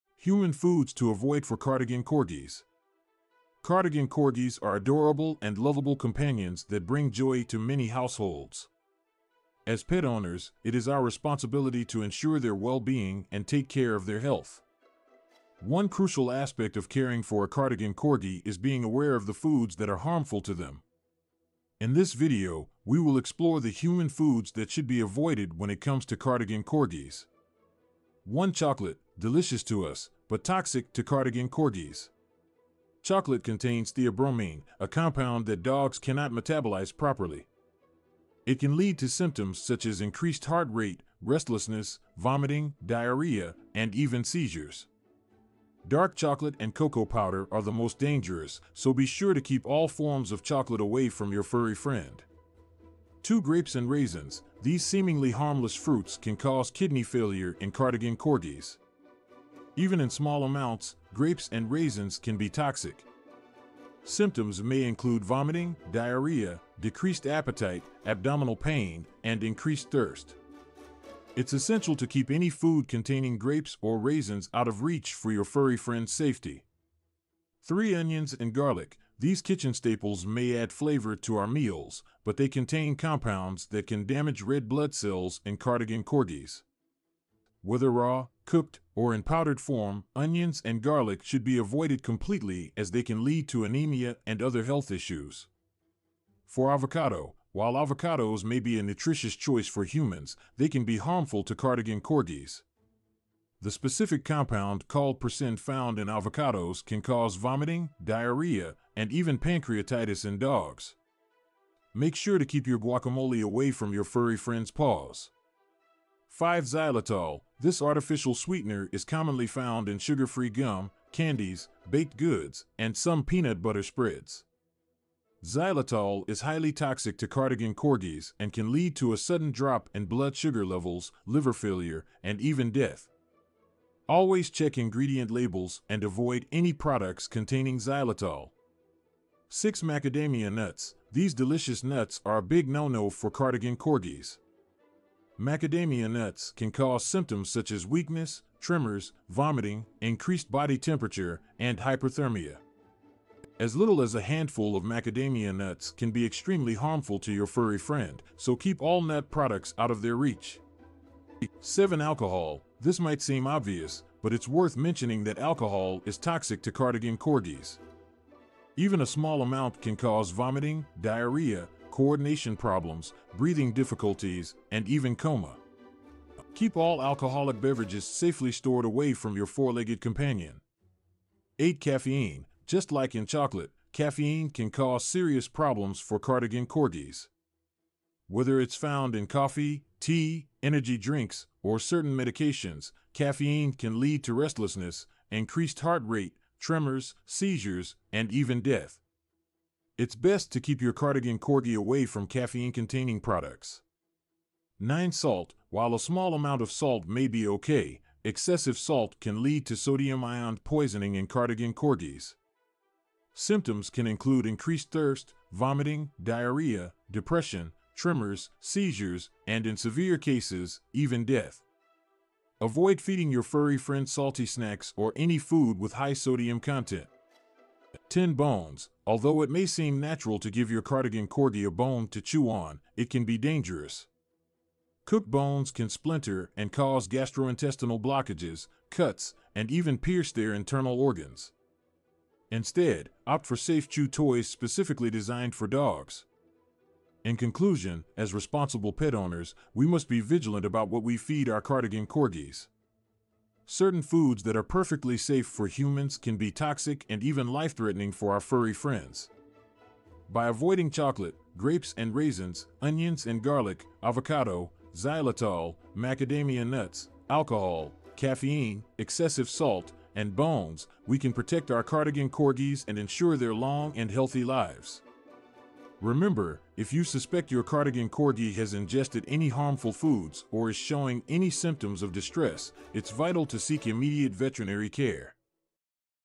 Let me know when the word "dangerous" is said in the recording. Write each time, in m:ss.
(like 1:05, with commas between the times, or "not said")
0:47, 3:53.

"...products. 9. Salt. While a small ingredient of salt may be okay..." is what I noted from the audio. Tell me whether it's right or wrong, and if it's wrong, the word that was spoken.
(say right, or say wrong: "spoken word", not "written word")
wrong: "amount", not "ingredient".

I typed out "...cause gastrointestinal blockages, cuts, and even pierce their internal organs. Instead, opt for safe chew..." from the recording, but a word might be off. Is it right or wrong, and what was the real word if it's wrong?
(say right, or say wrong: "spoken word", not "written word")
right.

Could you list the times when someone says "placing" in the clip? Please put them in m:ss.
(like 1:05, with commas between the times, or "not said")
not said.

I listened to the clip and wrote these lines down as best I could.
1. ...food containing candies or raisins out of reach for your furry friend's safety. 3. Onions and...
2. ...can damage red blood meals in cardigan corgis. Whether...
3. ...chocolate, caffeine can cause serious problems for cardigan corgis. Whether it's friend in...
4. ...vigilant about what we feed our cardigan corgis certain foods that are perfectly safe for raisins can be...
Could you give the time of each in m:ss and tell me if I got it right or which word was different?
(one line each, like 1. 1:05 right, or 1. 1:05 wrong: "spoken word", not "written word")
1. 1:12 wrong: "grapes", not "candies"
2. 1:23 wrong: "cells", not "meals"
3. 3:03 wrong: "found", not "friend"
4. 4:10 wrong: "humans", not "raisins".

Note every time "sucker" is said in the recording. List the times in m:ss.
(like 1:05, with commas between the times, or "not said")
not said.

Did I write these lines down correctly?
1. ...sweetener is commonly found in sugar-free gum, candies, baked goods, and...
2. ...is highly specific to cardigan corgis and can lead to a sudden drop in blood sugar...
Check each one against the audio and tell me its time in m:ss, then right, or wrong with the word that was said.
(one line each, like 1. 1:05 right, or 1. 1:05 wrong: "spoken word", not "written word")
1. 1:58 right
2. 2:06 wrong: "toxic", not "specific".